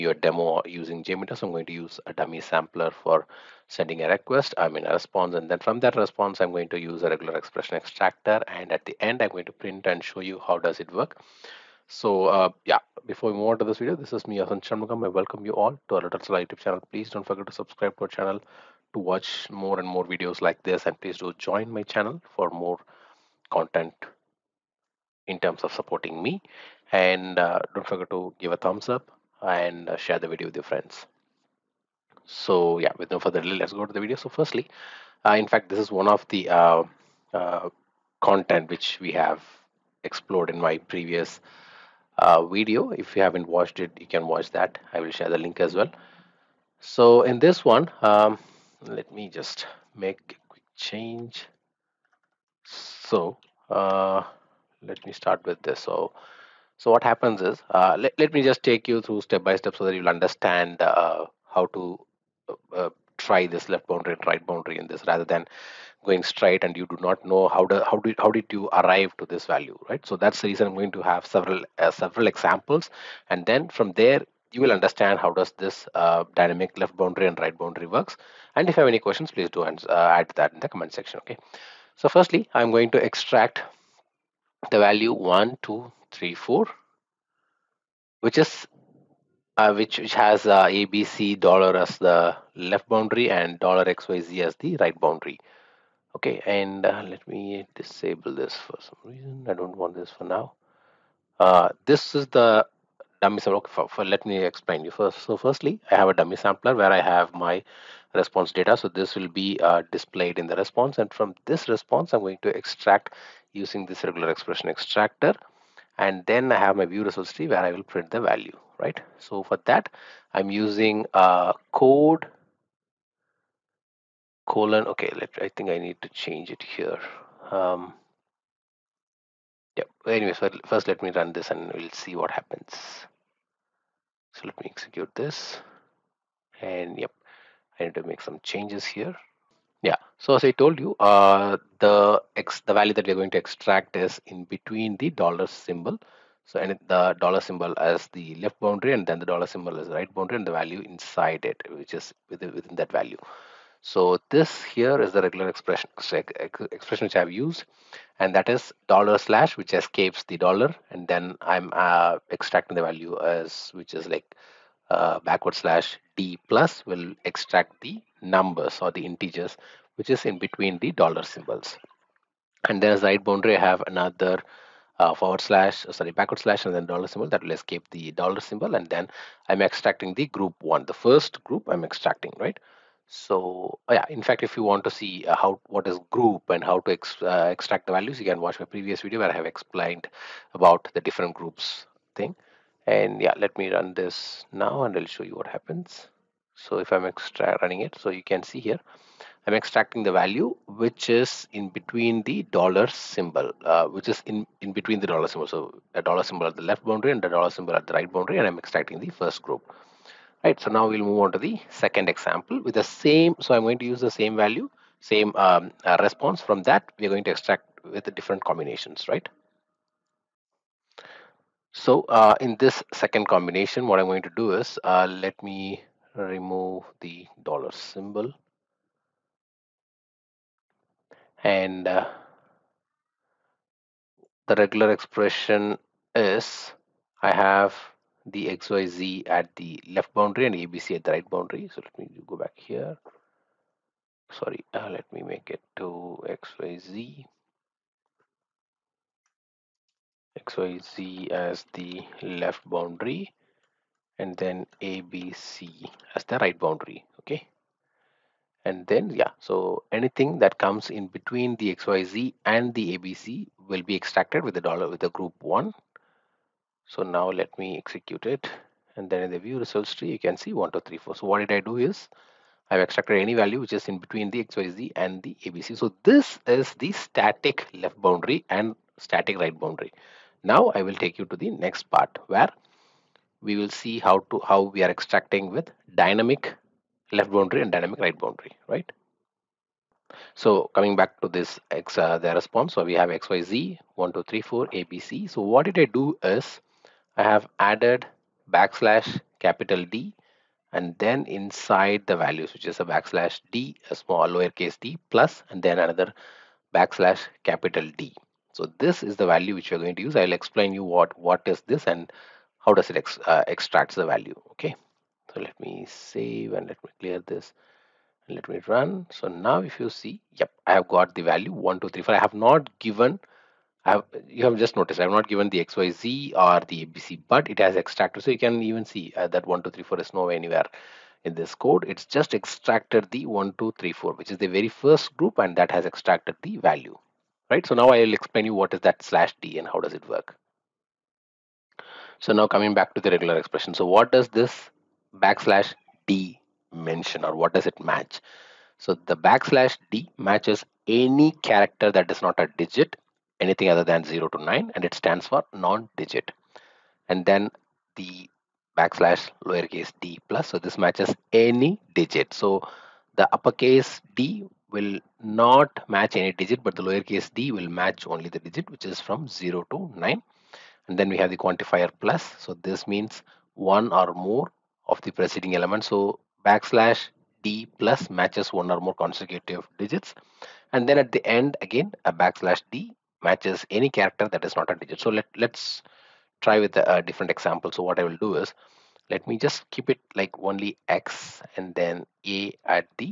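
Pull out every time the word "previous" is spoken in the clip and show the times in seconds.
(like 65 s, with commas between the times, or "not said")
40 s, 188 s.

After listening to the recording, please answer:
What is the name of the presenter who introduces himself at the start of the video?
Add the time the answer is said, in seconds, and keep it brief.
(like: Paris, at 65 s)
Asan Shanmugam, at 14 s.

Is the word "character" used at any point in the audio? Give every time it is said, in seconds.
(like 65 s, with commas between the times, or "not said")
351 s, 383 s.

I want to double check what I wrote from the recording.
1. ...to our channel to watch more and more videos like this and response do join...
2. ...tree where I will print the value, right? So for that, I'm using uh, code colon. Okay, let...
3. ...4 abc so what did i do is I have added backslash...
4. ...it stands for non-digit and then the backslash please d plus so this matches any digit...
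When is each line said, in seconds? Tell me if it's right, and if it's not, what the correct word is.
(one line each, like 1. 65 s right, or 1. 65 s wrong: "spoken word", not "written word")
1. 17 s wrong: "please", not "response"
2. 117 s right
3. 294 s right
4. 354 s wrong: "lowercase", not "please".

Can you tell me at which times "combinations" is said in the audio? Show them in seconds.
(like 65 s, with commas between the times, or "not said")
218 s, 223 s.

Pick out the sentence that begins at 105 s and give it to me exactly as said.
So firstly, I have a dummy sampler where I have my response data.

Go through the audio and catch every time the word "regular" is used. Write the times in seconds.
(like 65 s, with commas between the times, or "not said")
7 s, 114 s, 155 s, 234 s, 343 s.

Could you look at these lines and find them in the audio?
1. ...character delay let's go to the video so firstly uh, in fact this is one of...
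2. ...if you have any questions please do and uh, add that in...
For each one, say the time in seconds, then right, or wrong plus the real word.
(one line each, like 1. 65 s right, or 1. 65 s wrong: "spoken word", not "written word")
1. 33 s wrong: "further", not "character"
2. 78 s right.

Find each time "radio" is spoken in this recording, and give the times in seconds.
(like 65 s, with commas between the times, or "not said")
not said.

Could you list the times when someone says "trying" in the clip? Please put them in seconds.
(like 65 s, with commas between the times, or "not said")
not said.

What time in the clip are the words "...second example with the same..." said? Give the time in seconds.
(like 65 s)
211 s.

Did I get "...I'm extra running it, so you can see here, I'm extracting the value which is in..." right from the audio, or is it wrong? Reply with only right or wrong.
right.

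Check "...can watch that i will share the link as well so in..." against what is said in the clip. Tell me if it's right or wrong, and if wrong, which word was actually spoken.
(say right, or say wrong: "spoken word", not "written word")
right.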